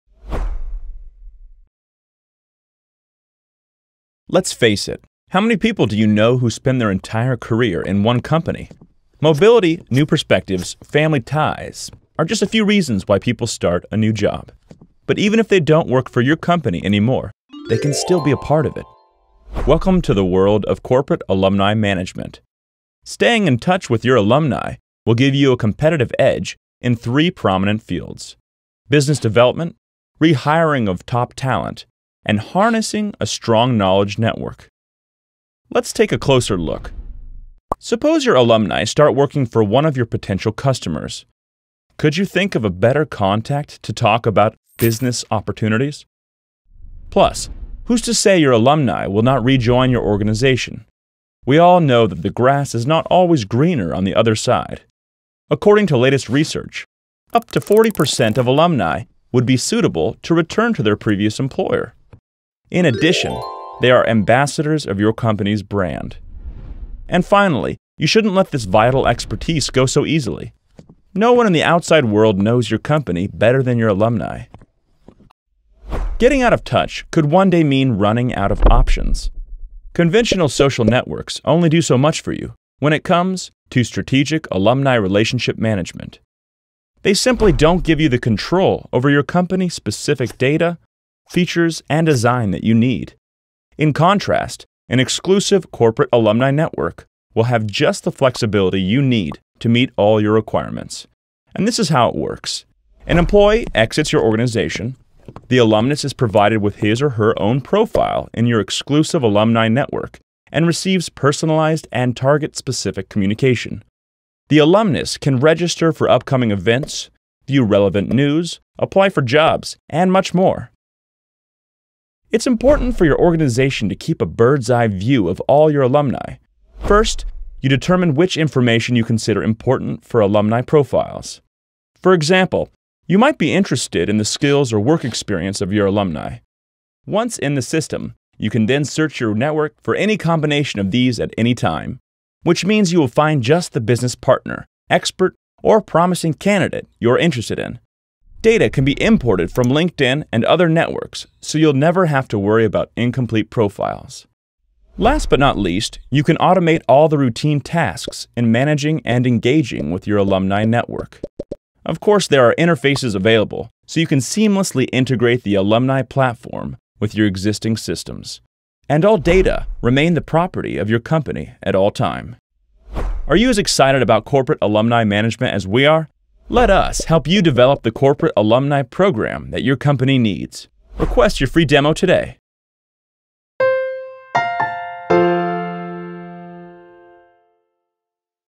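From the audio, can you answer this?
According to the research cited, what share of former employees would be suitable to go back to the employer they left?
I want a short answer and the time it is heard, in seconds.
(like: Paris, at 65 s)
40%, at 57 s.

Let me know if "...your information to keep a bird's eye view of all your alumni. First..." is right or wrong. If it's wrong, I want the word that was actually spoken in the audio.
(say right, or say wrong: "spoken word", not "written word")
wrong: "organization", not "information".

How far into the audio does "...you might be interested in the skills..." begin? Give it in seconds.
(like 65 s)
133 s.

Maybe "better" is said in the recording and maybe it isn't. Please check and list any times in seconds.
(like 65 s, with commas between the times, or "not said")
42 s, 73 s.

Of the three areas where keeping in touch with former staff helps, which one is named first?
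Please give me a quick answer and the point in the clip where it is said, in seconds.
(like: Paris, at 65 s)
business development, at 28 s.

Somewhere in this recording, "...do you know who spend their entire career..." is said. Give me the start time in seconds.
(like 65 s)
5 s.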